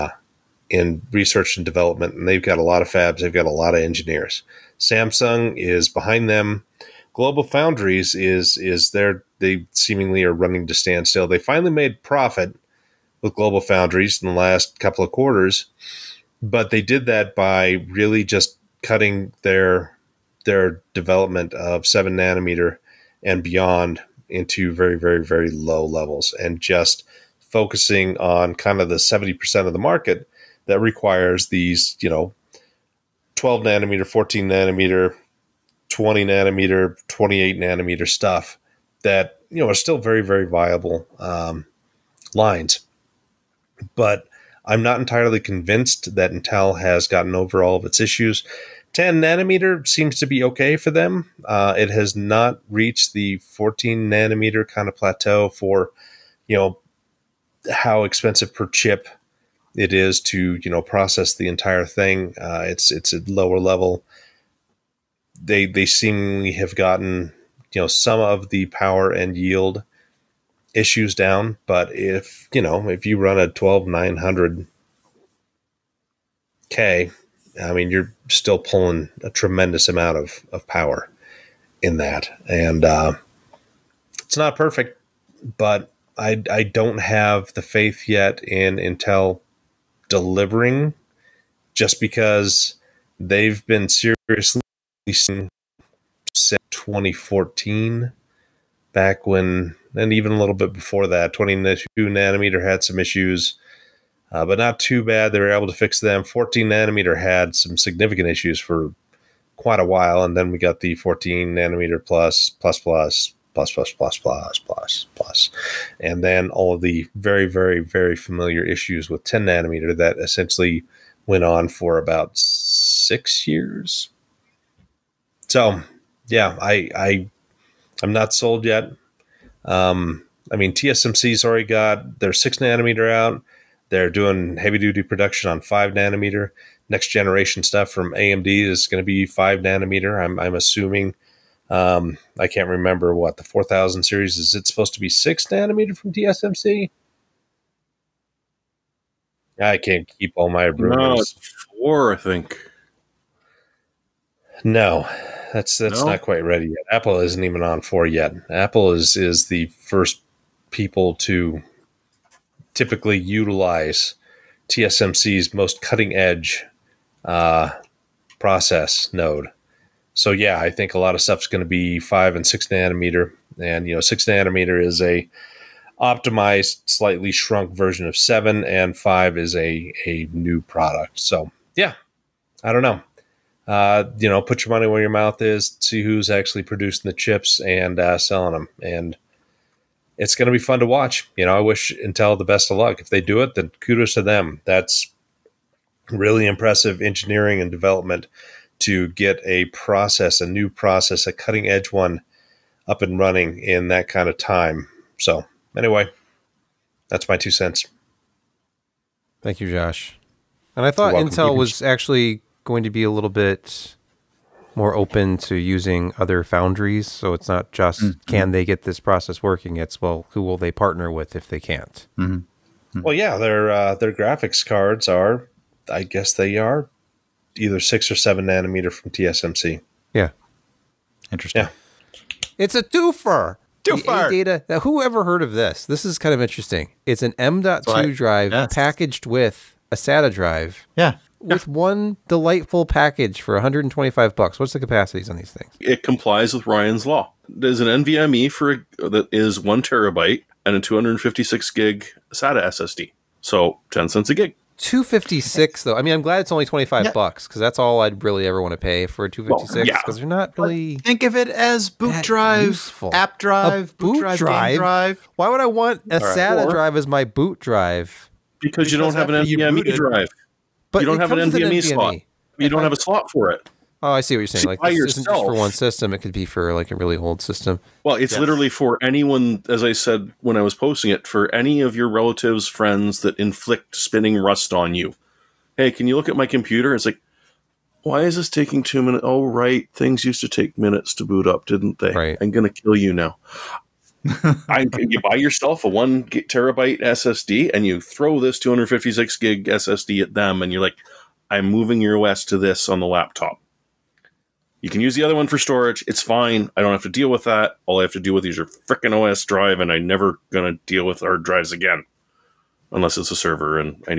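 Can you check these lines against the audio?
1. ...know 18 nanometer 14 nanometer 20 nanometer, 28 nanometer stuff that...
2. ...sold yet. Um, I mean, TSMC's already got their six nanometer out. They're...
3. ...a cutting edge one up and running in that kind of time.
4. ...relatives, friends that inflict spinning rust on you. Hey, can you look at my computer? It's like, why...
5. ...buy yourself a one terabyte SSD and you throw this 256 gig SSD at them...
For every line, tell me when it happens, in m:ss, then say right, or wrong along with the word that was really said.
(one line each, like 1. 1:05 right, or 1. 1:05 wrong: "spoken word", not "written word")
1. 0:32 wrong: "12", not "18"
2. 2:08 right
3. 3:21 right
4. 4:42 right
5. 4:55 right.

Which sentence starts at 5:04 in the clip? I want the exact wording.
You can use the other one for storage.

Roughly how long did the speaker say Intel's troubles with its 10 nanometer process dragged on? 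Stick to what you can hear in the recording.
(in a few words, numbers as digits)
about six years.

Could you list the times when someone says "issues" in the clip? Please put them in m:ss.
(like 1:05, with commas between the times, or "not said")
0:47, 1:10, 1:42, 1:48, 1:58.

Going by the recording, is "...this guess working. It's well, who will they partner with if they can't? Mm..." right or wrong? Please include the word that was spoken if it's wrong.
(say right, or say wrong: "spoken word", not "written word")
wrong: "process", not "guess".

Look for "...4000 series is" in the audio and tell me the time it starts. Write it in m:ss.
2:23.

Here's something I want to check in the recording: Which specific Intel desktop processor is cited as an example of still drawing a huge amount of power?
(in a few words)
12900K.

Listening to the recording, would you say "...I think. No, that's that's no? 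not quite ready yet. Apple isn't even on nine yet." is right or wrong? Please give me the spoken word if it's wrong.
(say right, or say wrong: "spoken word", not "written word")
wrong: "four", not "nine".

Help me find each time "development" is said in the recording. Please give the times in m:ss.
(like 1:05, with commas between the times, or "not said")
0:01, 0:20, 3:17.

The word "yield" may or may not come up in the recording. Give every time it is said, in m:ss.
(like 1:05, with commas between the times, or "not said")
1:09.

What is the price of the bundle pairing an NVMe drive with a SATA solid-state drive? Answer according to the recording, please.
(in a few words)
$125.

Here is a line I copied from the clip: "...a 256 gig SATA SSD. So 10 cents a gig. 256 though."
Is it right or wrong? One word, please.
right.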